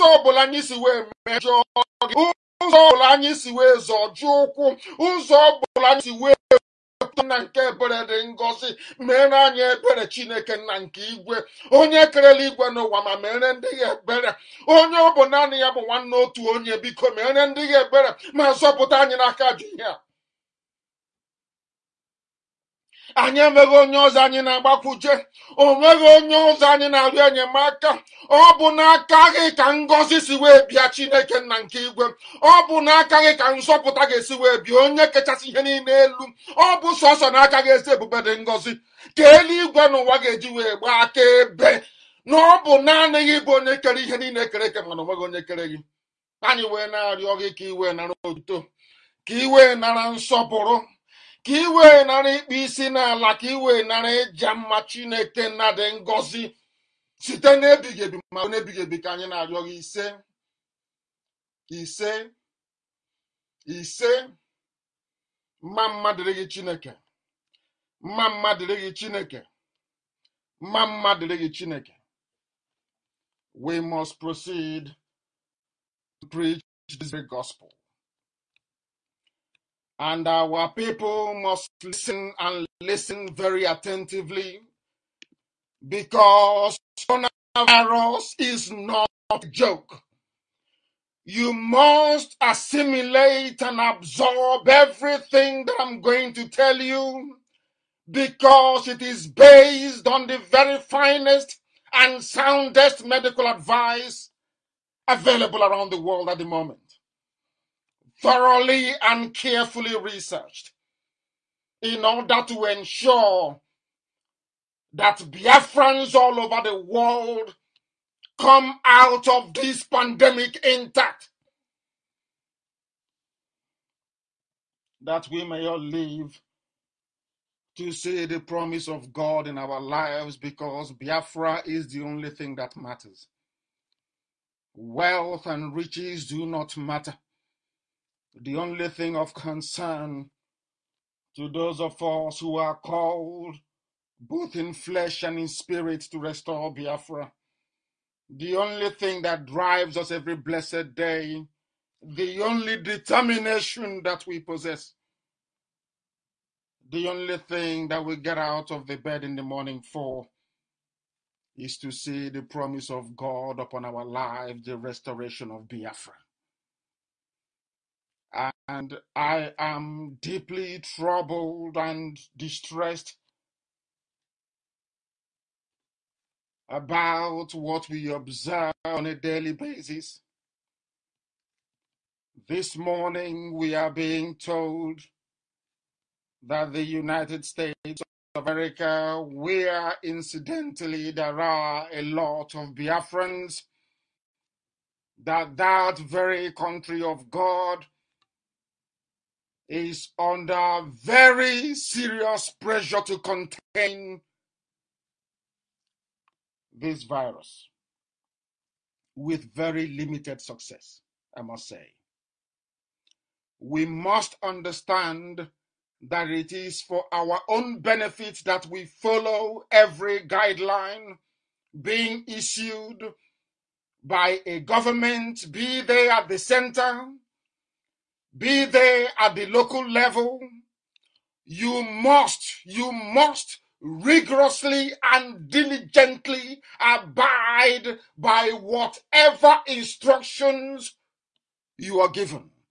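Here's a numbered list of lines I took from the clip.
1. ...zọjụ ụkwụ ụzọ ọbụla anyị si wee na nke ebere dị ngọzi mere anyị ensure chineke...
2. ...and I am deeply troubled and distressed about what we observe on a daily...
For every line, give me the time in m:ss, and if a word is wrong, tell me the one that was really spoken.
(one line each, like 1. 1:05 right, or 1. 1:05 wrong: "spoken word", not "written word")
1. 0:03 wrong: "ebere", not "ensure"
2. 2:48 right.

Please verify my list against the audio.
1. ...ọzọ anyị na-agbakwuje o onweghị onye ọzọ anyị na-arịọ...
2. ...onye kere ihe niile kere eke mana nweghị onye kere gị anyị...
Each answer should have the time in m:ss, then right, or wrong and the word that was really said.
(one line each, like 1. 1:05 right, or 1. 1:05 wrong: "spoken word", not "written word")
1. 0:24 wrong: "nweghị", not "onweghị"
2. 0:43 wrong: "onweghị", not "nweghị".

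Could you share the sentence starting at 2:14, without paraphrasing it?
Wealth and riches do not matter.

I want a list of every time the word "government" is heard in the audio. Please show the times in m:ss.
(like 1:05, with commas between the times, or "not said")
3:44.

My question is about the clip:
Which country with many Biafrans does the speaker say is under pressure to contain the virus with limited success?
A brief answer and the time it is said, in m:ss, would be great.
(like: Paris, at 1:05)
United States of America, at 3:06.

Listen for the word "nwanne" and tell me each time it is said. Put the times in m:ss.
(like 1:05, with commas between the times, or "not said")
0:15.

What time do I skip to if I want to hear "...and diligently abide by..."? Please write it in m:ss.
3:55.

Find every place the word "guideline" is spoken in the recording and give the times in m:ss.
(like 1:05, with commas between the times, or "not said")
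3:40.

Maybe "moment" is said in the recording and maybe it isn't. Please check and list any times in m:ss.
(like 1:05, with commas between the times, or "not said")
1:46.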